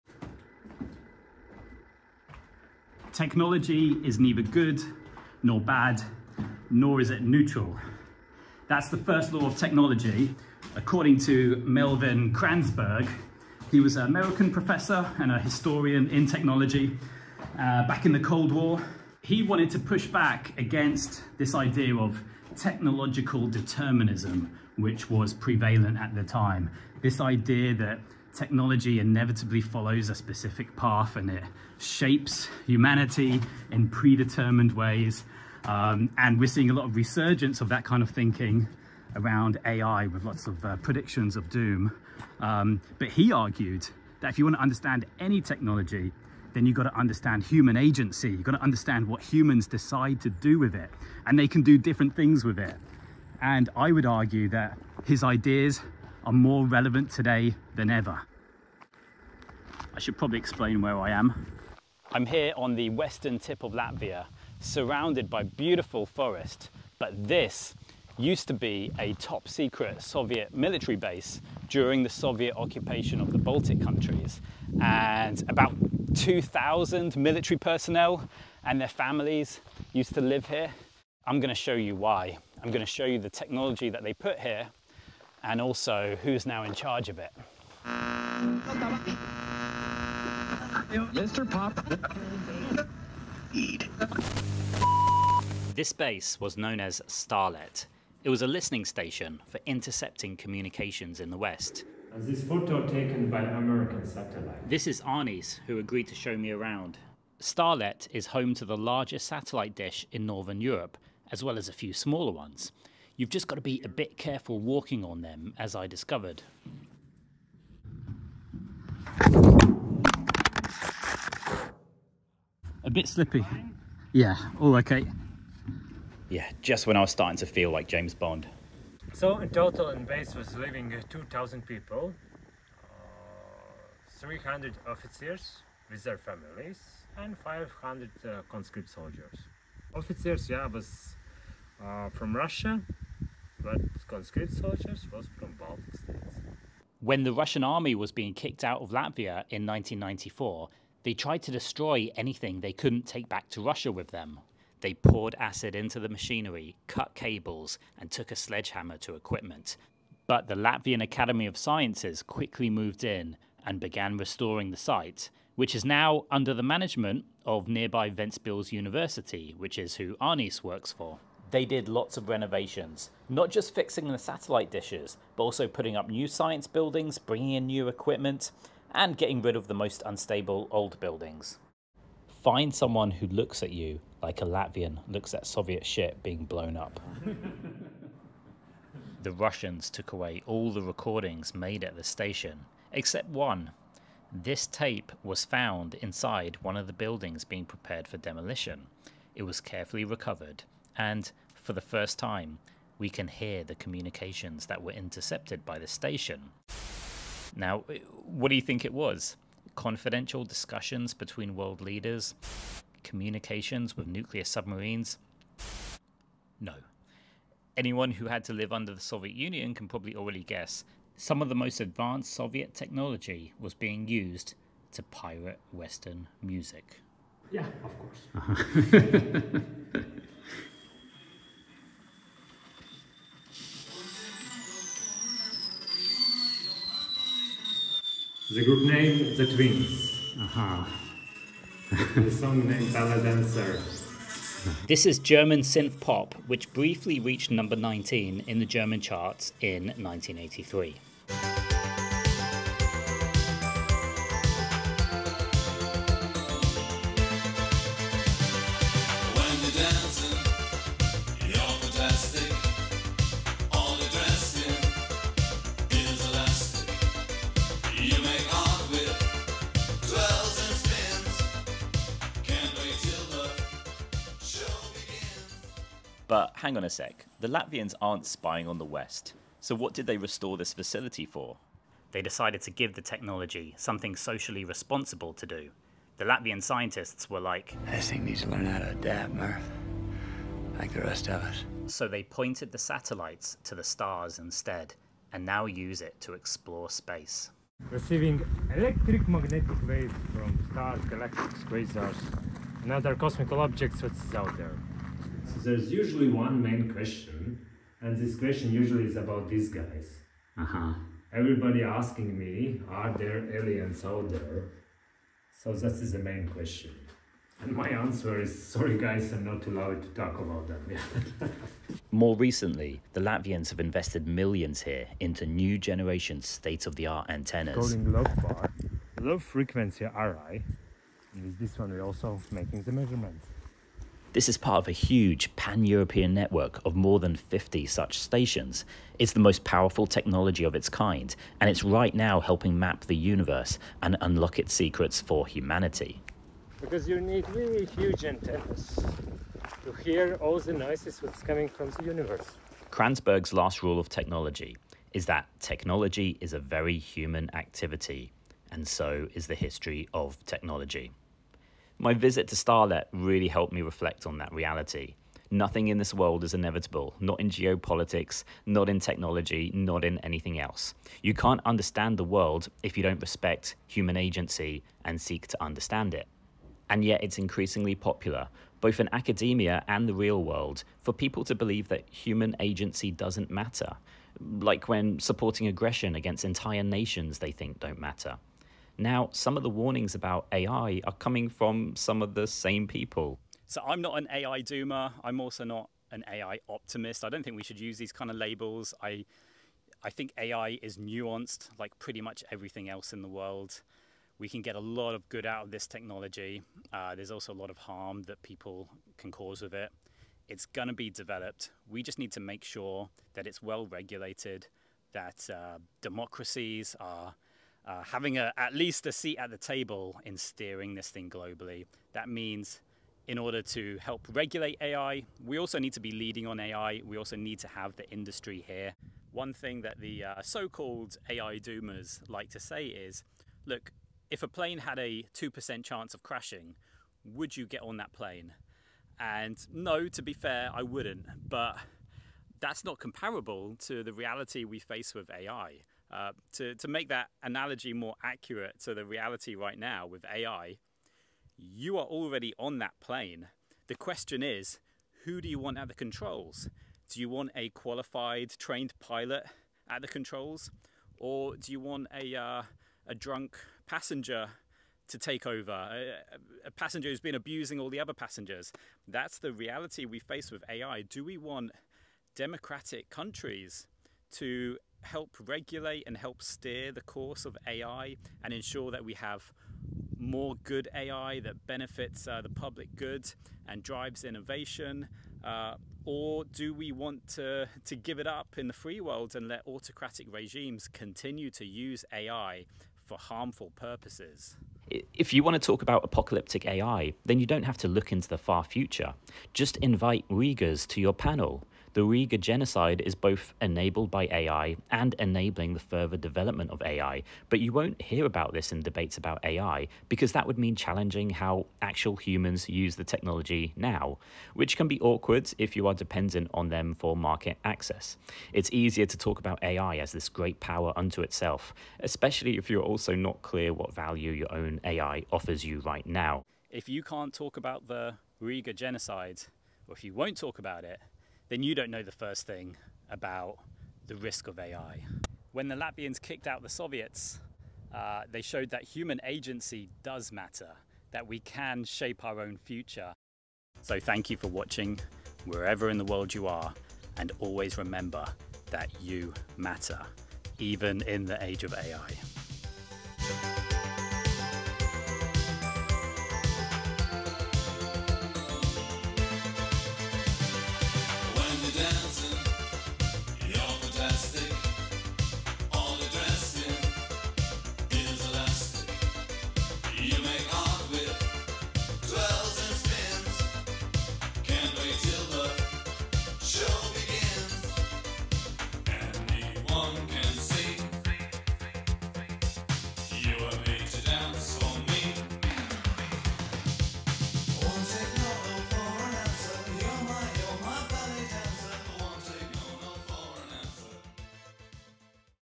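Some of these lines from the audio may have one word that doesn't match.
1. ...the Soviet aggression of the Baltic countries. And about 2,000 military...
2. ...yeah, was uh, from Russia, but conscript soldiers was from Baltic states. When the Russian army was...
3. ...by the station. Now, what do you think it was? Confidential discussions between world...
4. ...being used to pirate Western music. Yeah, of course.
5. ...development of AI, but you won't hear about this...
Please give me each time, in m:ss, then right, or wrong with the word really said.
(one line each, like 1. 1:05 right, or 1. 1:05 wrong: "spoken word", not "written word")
1. 1:12 wrong: "occupation", not "aggression"
2. 2:20 right
3. 3:25 right
4. 3:43 right
5. 8:26 right.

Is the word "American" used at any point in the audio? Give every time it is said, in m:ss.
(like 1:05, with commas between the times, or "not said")
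0:14, 1:43.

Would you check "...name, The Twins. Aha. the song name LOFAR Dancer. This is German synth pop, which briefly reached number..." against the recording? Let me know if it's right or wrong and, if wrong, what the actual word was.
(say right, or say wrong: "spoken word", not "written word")
wrong: "Ballet", not "LOFAR".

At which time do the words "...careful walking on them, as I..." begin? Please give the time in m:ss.
1:54.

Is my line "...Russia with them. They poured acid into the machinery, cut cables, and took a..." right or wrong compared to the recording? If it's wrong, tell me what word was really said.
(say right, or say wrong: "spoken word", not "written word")
right.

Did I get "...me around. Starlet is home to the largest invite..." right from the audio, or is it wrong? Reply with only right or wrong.
wrong.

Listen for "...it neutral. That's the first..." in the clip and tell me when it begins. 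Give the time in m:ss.
0:07.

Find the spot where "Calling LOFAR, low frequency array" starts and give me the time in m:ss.
5:27.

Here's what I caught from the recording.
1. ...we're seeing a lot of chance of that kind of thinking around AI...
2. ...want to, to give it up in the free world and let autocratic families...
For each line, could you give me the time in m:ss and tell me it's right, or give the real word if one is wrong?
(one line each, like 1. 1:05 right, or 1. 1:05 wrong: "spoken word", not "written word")
1. 0:36 wrong: "resurgence", not "chance"
2. 8:06 wrong: "regimes", not "families".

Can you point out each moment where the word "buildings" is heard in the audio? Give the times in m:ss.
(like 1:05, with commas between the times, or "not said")
2:56, 3:00, 3:16.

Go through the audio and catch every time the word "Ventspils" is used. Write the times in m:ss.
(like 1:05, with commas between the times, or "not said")
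2:48.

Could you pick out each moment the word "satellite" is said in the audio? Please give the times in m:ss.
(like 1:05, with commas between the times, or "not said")
1:44, 1:49, 2:54, 4:52.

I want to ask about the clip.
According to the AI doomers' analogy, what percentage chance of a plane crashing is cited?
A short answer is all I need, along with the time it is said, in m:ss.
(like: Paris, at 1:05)
2%, at 7:15.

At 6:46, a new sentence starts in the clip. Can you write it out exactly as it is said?
Uh, there's also a lot of harm that people can cause with it.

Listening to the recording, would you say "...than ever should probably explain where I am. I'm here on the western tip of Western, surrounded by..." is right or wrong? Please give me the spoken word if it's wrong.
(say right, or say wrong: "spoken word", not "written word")
wrong: "Latvia", not "Western".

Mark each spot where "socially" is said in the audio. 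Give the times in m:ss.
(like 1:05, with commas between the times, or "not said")
4:44.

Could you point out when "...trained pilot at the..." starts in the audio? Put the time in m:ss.
7:38.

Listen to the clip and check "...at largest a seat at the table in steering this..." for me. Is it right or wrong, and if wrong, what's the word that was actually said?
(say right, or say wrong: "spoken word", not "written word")
wrong: "least", not "largest".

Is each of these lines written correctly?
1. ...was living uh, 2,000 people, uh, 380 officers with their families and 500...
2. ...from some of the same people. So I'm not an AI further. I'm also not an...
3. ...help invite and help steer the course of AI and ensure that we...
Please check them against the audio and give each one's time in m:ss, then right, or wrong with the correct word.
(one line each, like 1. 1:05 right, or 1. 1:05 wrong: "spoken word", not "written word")
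1. 2:10 wrong: "300", not "380"
2. 6:31 wrong: "doomer", not "further"
3. 7:55 wrong: "regulate", not "invite".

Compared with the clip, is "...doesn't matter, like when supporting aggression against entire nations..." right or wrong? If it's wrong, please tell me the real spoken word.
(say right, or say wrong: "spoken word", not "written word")
right.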